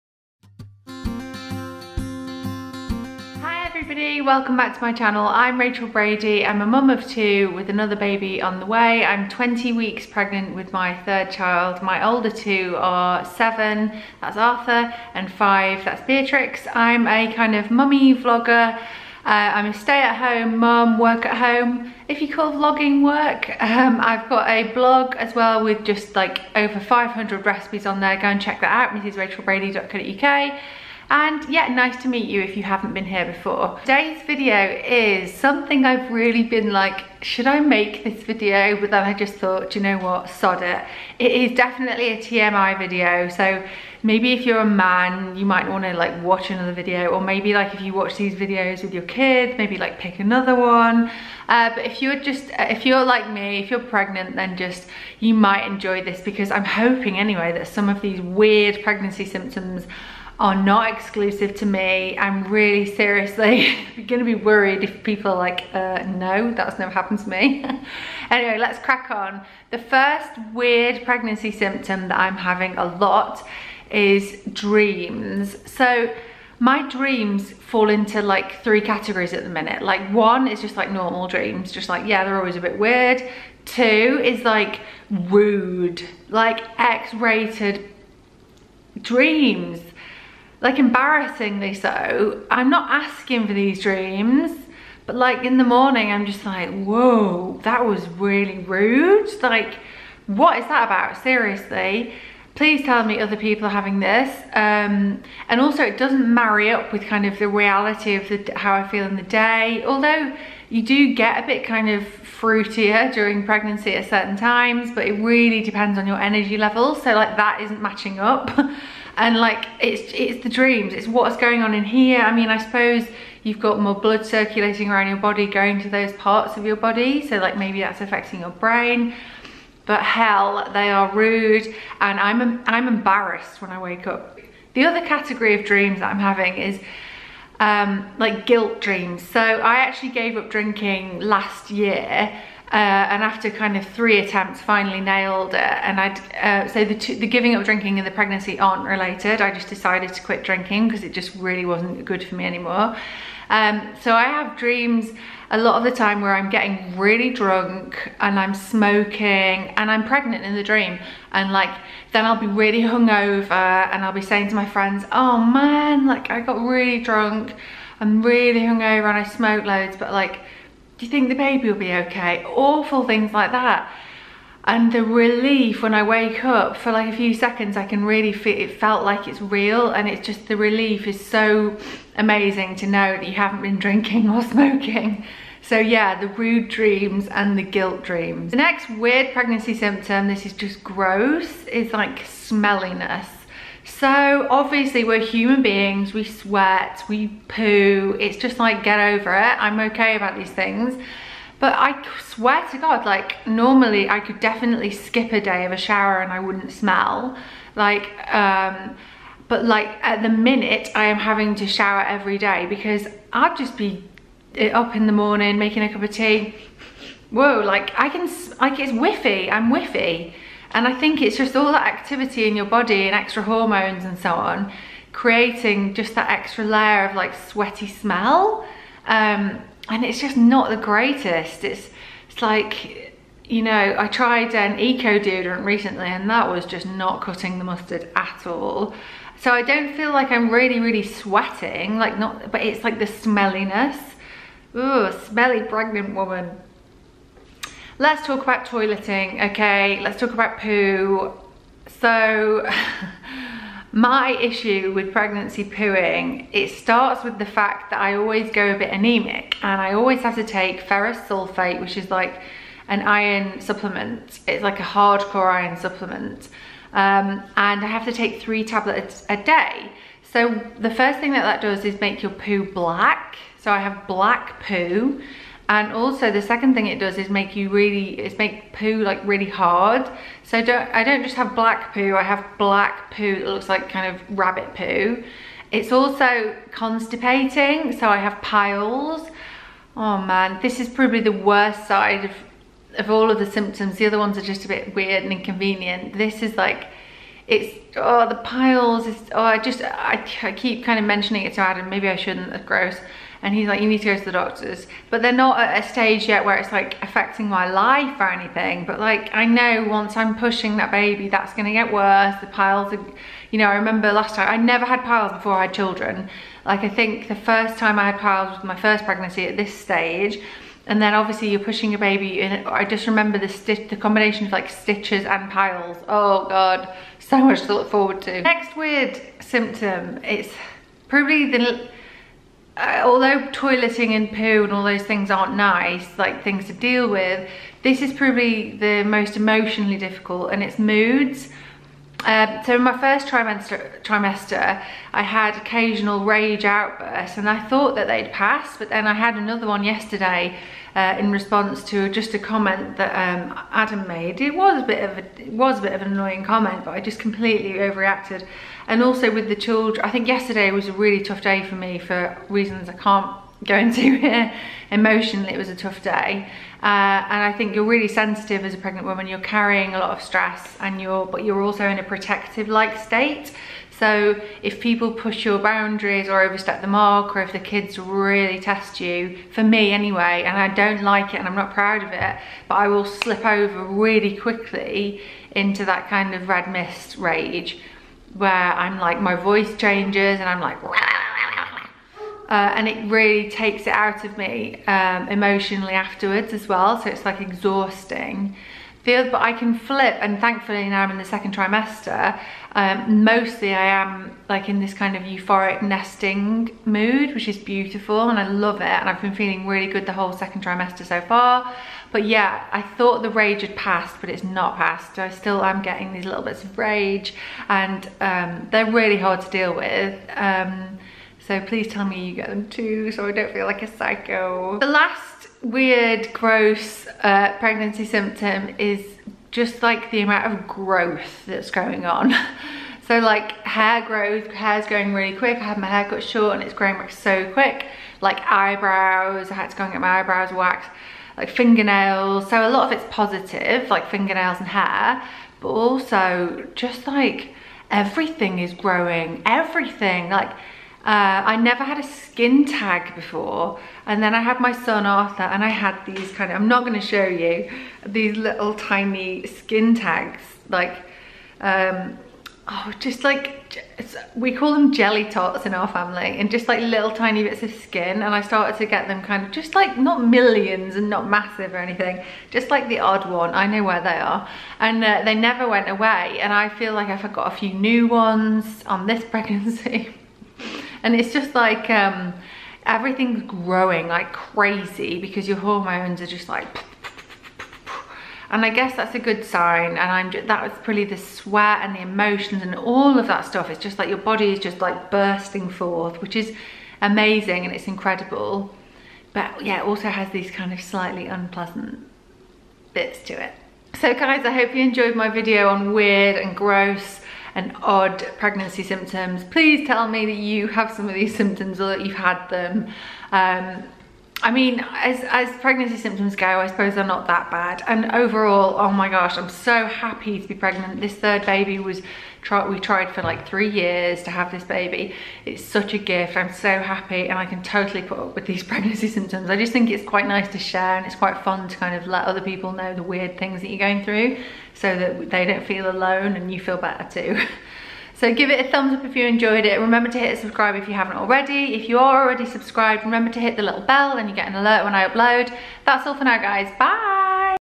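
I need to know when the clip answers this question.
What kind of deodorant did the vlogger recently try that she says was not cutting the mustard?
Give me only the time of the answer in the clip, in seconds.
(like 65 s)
234 s.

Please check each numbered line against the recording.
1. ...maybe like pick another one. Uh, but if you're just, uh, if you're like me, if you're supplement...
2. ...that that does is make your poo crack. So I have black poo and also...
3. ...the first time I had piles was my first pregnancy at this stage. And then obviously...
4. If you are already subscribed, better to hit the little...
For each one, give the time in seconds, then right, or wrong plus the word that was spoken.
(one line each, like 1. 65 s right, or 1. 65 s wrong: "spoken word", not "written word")
1. 49 s wrong: "pregnant", not "supplement"
2. 271 s wrong: "black", not "crack"
3. 317 s right
4. 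541 s wrong: "remember", not "better".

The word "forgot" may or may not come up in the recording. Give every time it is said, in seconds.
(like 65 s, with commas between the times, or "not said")
477 s.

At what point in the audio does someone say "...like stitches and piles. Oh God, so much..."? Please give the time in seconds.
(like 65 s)
324 s.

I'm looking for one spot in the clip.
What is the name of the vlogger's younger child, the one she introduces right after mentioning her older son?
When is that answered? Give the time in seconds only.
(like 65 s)
16 s.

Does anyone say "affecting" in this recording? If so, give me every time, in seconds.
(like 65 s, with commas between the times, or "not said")
128 s, 307 s.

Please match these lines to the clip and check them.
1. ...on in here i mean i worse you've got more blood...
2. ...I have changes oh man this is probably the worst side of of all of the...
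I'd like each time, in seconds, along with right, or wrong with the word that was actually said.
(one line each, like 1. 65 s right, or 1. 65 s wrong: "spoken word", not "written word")
1. 121 s wrong: "suppose", not "worse"
2. 288 s wrong: "piles", not "changes".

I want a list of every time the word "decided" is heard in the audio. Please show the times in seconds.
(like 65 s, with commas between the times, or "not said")
149 s.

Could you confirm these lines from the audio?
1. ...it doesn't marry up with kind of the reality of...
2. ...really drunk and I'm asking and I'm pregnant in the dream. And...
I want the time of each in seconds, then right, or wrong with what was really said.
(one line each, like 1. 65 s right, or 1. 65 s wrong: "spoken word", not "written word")
1. 105 s right
2. 156 s wrong: "smoking", not "asking".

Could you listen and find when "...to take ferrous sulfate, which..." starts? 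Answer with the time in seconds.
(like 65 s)
260 s.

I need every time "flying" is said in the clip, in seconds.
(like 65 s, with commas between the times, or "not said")
not said.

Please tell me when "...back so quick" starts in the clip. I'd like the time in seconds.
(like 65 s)
436 s.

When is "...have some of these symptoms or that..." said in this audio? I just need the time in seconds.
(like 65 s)
510 s.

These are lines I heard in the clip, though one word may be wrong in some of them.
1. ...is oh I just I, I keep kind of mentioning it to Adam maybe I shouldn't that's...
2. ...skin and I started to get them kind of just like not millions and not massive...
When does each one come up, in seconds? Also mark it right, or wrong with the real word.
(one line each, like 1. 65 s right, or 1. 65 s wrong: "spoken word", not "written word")
1. 299 s right
2. 467 s right.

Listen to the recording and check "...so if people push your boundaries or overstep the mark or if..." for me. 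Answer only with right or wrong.
right.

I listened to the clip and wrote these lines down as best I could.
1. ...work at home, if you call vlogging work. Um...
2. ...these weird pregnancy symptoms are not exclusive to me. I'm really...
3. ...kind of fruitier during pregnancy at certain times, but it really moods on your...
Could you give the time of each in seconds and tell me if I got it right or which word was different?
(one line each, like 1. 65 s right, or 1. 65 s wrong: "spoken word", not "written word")
1. 20 s right
2. 57 s right
3. 111 s wrong: "depends", not "moods".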